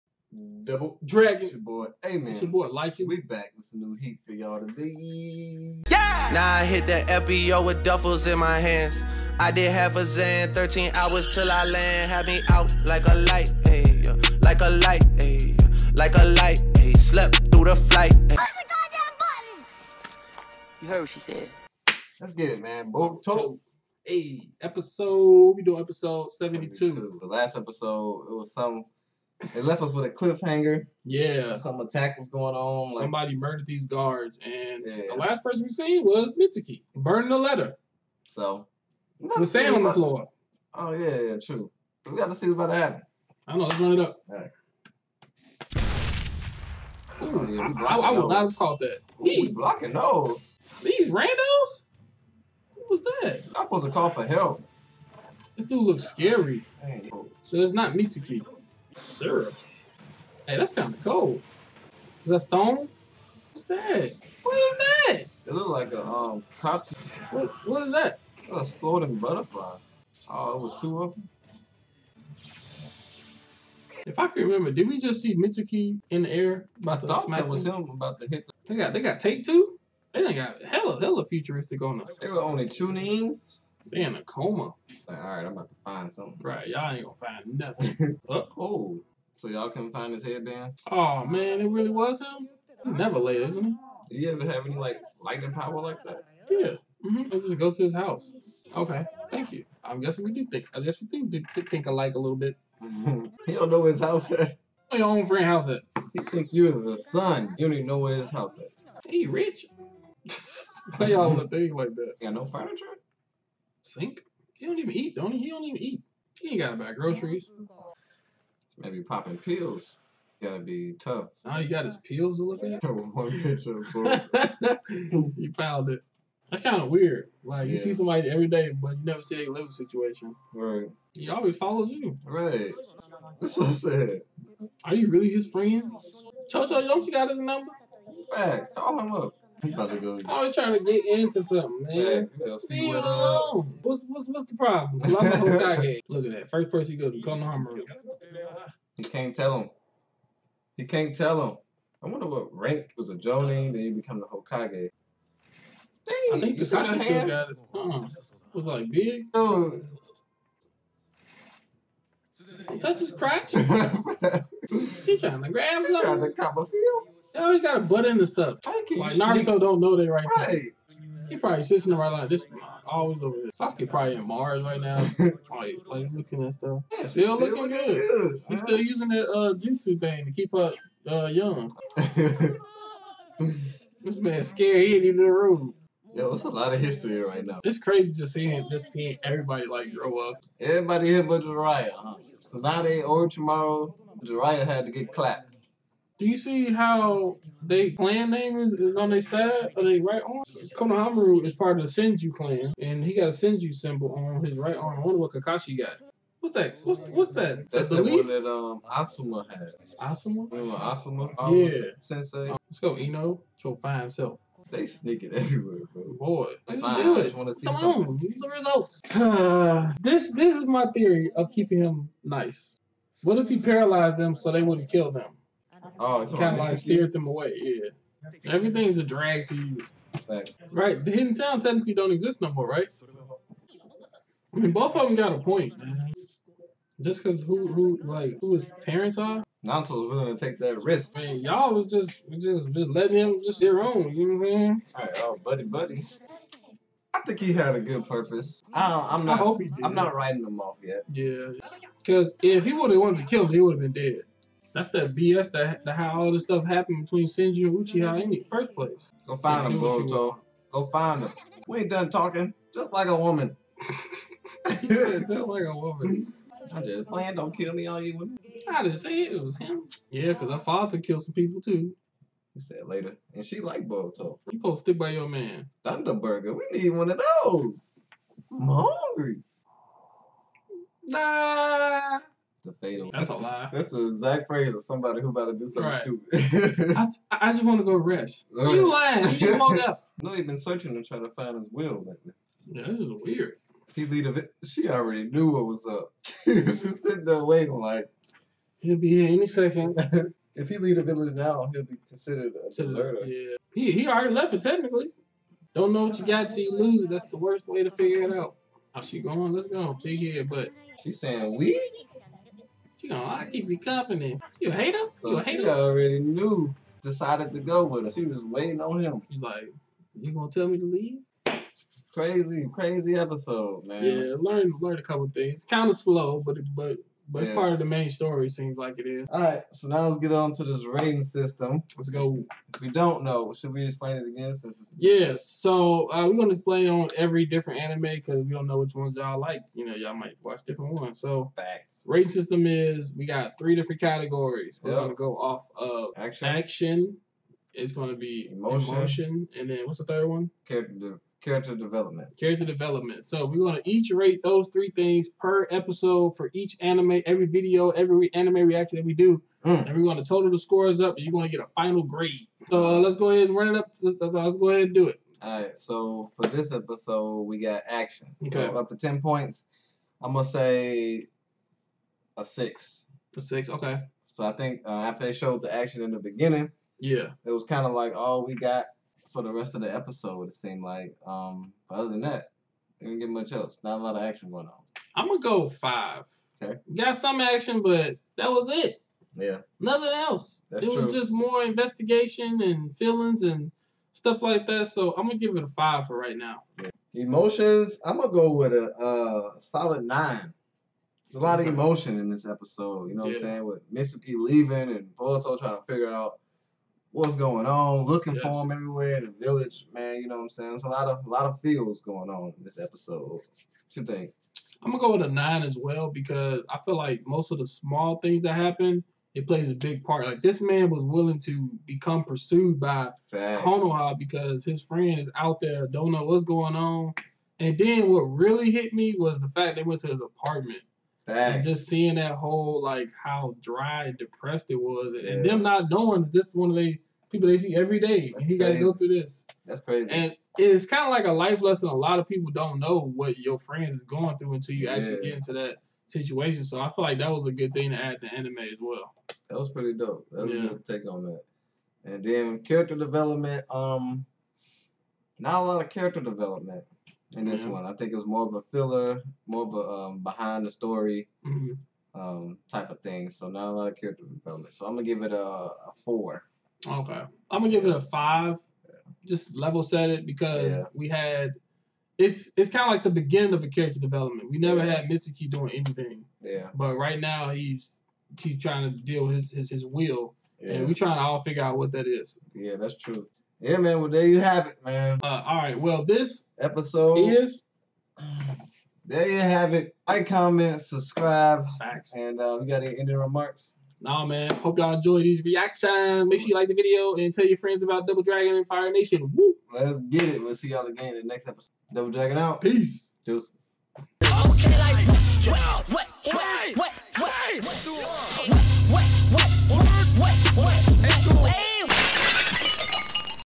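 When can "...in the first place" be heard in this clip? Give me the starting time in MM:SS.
04:18.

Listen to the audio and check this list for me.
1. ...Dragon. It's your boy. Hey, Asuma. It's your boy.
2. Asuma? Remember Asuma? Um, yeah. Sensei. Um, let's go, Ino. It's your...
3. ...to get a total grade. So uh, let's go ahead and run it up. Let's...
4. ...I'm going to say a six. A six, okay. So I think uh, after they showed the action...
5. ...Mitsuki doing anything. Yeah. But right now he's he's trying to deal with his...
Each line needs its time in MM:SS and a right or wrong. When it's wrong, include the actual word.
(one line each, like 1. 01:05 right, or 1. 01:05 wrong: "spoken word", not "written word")
1. 00:01 wrong: "Amen", not "Asuma"
2. 03:29 right
3. 06:01 wrong: "final", not "total"
4. 06:10 right
5. 07:55 right.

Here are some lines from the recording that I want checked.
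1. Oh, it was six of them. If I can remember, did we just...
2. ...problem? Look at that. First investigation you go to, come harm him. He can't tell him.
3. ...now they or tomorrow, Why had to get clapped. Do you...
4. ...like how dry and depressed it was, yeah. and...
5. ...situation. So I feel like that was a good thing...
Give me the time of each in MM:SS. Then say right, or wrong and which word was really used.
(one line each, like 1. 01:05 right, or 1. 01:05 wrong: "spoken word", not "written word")
1. 01:10 wrong: "two", not "six"
2. 02:24 wrong: "person", not "investigation"
3. 03:12 wrong: "Jiraiya", not "Why"
4. 07:12 right
5. 07:26 right.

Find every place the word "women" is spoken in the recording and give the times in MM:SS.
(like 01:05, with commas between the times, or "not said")
04:28.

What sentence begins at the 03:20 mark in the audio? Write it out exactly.
Konohamaru is part of the Senju clan, and he got a Senju symbol on his right arm.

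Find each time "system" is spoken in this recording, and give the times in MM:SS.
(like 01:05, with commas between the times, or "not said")
05:31, 05:42.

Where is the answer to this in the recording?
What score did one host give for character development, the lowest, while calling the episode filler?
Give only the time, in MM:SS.
07:46.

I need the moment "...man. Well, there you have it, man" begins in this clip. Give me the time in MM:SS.
08:03.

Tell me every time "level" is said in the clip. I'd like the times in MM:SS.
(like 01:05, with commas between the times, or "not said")
07:49.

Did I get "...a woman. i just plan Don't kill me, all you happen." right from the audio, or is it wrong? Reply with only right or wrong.
wrong.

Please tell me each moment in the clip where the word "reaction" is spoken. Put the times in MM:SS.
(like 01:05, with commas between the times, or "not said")
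05:58, 08:15.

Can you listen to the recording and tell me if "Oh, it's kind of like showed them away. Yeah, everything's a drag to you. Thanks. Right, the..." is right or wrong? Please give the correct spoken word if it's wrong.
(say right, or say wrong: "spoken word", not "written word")
wrong: "steered", not "showed".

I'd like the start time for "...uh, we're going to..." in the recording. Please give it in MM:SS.
05:36.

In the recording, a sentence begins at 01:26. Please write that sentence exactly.
Right, y'all ain't gonna find nothing.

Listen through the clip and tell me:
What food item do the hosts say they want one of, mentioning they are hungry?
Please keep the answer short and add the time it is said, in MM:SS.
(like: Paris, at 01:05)
Thunderburger, at 04:35.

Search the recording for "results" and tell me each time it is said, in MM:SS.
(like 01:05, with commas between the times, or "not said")
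03:38.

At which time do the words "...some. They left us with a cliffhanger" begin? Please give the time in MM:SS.
00:28.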